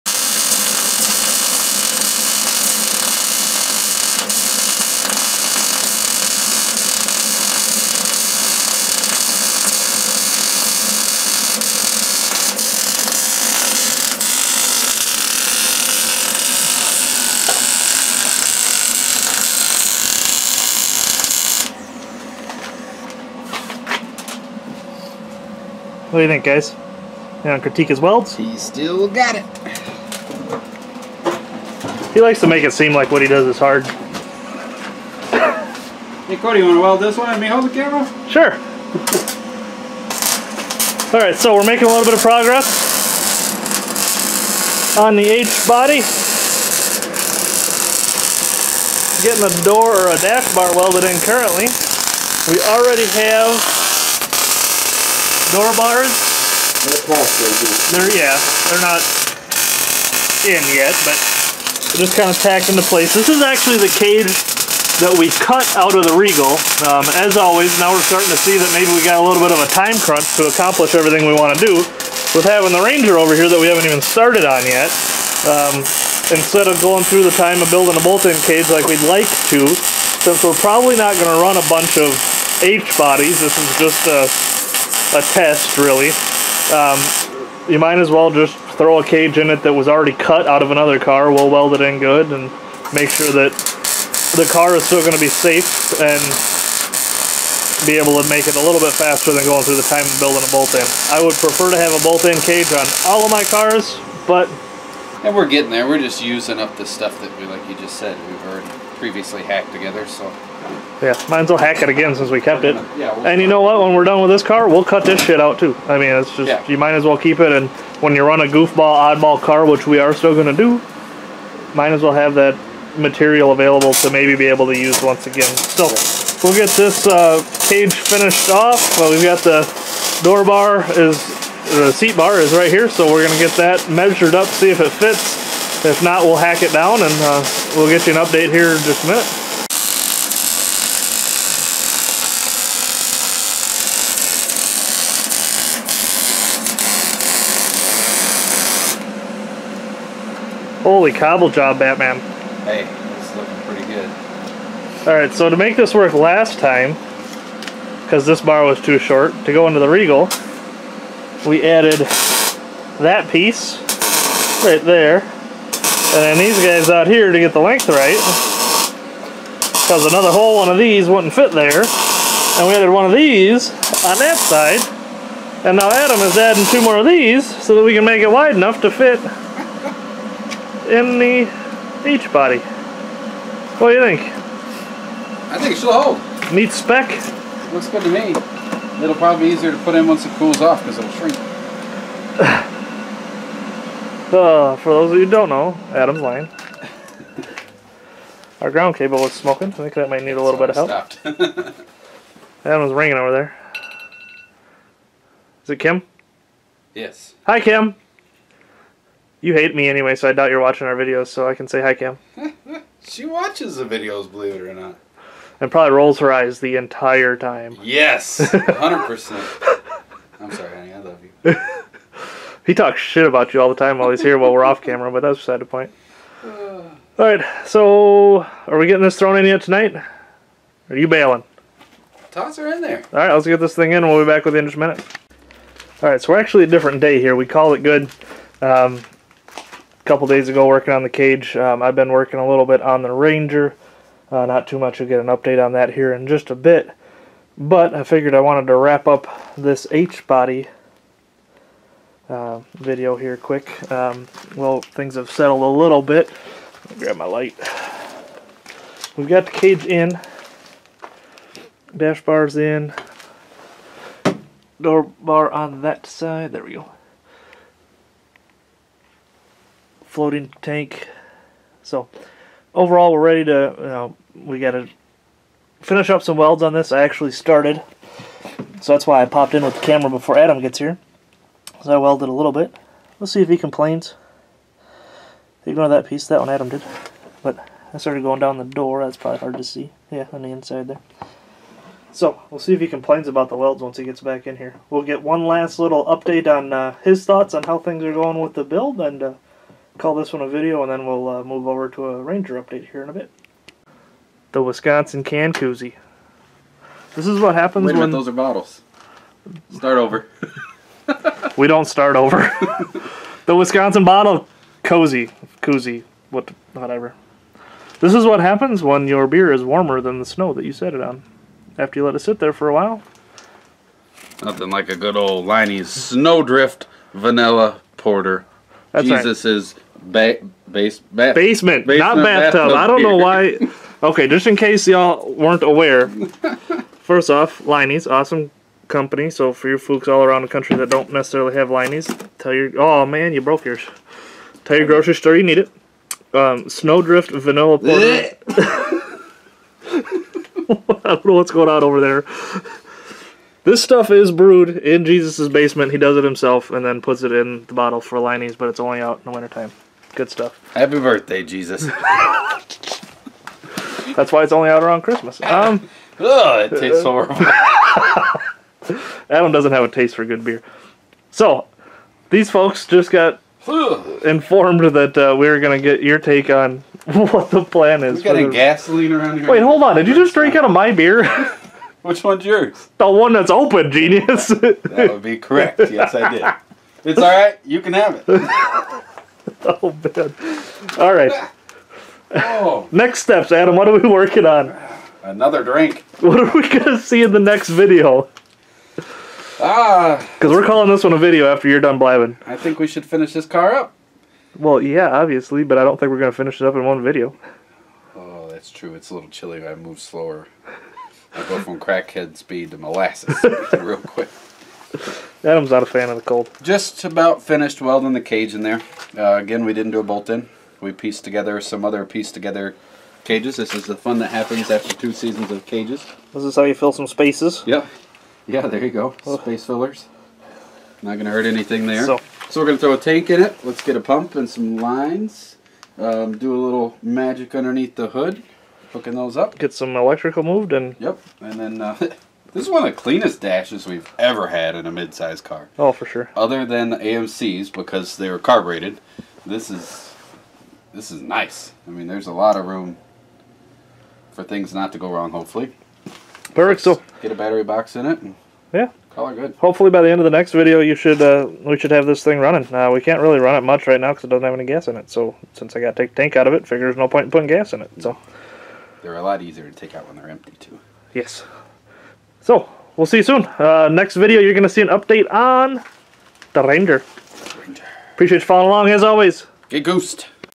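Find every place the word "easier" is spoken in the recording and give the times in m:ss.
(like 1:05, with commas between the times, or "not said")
3:09, 7:49.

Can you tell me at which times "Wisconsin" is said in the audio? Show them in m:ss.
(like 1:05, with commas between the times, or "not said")
5:04, 5:13.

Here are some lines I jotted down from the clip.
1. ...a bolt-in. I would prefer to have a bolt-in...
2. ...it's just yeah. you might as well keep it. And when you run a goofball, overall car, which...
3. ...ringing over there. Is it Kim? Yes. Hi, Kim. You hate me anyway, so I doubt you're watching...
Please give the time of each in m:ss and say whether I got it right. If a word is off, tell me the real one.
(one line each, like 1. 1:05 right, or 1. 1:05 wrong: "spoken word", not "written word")
1. 1:40 right
2. 1:56 wrong: "oddball", not "overall"
3. 3:22 right.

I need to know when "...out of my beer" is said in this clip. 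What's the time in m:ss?
6:20.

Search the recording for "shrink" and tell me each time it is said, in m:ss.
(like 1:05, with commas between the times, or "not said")
3:11.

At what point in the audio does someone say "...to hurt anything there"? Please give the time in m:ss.
7:11.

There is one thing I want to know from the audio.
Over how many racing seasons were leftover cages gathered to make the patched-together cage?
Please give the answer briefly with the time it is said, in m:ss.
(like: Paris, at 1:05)
2, at 7:04.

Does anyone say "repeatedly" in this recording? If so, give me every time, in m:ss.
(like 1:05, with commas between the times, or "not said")
not said.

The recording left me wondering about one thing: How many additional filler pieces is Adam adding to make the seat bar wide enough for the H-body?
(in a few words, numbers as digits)
2.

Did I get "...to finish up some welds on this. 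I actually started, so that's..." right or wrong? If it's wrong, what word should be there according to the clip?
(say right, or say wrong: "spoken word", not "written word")
right.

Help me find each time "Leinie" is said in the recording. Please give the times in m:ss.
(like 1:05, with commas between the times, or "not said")
5:25, 5:37, 5:41, 5:58.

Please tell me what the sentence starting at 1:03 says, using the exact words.
This is actually the cage that we cut out of the Regal.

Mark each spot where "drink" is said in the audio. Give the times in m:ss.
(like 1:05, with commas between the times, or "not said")
6:20, 6:35.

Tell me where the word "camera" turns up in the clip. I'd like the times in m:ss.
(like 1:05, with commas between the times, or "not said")
0:37, 3:44, 4:39.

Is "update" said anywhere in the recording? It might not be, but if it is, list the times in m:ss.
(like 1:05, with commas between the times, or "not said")
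2:18, 4:05, 4:56, 5:02, 7:54.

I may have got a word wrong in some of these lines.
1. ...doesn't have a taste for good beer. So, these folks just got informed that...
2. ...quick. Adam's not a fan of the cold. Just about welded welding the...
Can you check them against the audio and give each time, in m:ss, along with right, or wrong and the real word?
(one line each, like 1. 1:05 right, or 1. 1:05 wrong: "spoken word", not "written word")
1. 6:09 right
2. 6:53 wrong: "finished", not "welded".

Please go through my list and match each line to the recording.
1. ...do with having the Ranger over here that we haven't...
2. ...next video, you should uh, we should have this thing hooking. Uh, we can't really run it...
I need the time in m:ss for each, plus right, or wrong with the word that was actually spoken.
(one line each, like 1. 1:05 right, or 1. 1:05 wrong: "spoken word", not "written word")
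1. 1:11 right
2. 7:40 wrong: "running", not "hooking".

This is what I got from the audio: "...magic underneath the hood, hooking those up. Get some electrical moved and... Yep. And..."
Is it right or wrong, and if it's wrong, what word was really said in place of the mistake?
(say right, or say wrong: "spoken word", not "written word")
right.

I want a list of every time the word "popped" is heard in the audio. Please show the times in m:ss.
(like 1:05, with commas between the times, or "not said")
4:39.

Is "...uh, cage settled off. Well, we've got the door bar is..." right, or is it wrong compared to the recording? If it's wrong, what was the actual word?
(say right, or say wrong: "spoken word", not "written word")
wrong: "finished", not "settled".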